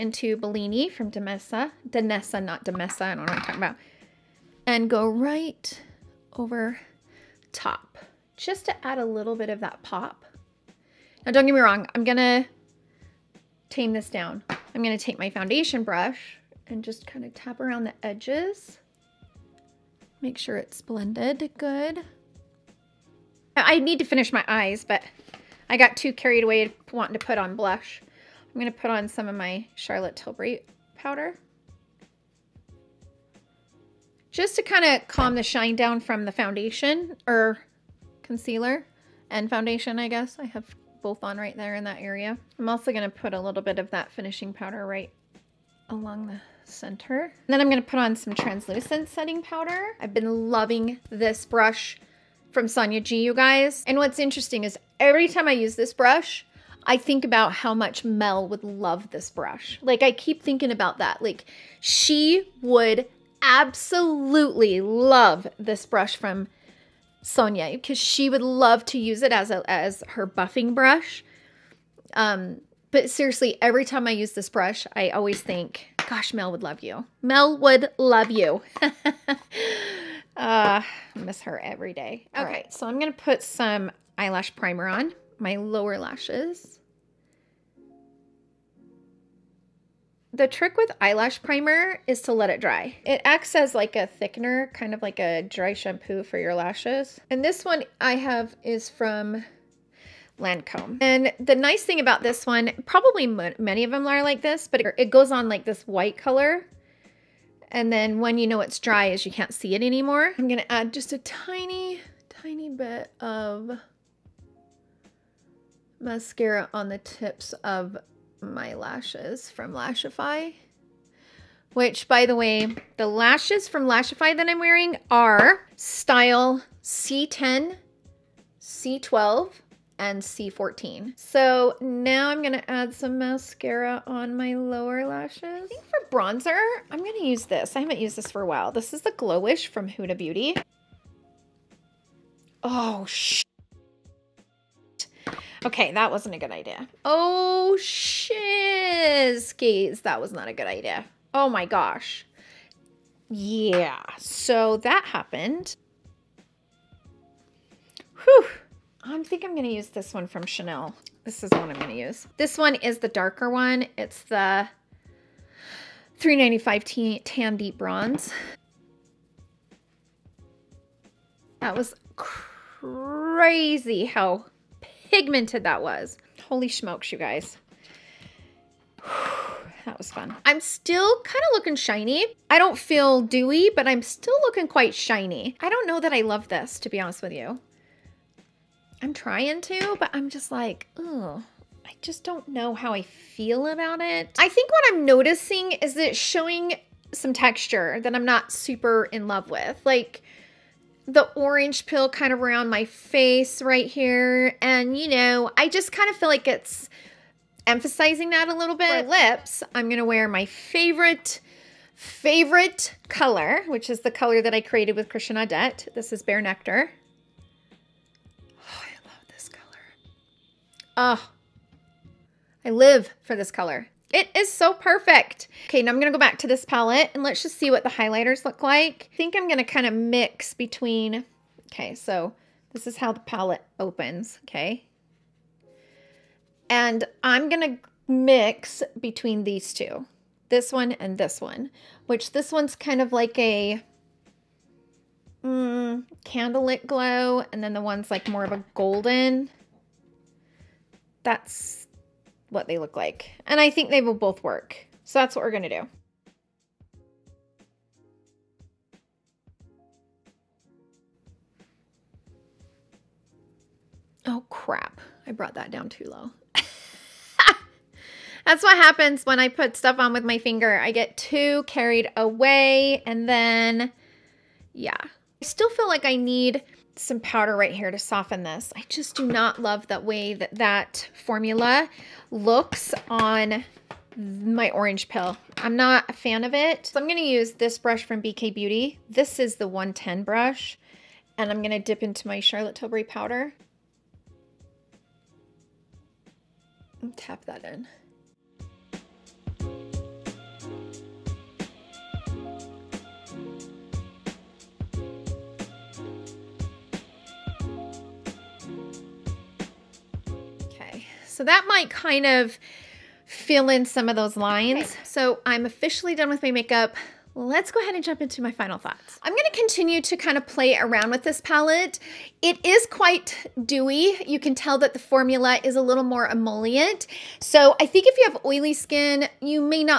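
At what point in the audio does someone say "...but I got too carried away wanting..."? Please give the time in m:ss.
0:24.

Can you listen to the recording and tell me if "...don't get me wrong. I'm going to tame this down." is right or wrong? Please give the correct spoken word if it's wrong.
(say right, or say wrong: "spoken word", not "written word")
right.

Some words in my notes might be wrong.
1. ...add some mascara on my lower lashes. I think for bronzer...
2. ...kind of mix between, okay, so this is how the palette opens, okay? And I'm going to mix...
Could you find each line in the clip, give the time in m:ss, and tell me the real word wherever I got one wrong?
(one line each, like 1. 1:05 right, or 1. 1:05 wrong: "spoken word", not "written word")
1. 2:12 right
2. 3:49 right.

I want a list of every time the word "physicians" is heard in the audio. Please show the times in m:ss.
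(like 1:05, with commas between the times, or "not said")
not said.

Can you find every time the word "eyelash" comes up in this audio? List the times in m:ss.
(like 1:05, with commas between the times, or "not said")
1:24, 1:30.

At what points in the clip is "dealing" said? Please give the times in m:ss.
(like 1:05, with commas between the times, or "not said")
not said.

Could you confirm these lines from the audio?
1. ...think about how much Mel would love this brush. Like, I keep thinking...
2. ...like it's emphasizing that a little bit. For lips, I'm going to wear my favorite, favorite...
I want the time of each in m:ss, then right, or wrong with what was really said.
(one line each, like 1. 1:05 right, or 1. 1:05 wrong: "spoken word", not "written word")
1. 0:56 right
2. 3:26 right.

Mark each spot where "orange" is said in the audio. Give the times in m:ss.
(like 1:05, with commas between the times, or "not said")
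3:21, 4:44.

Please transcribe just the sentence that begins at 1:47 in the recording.
And then when you know it's dry is you can't see it anymore.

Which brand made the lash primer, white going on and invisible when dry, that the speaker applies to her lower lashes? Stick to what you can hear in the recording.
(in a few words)
Lancome.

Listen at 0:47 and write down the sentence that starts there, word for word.
And then I'm going to put on some translucent setting powder.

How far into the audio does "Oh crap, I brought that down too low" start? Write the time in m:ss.
4:24.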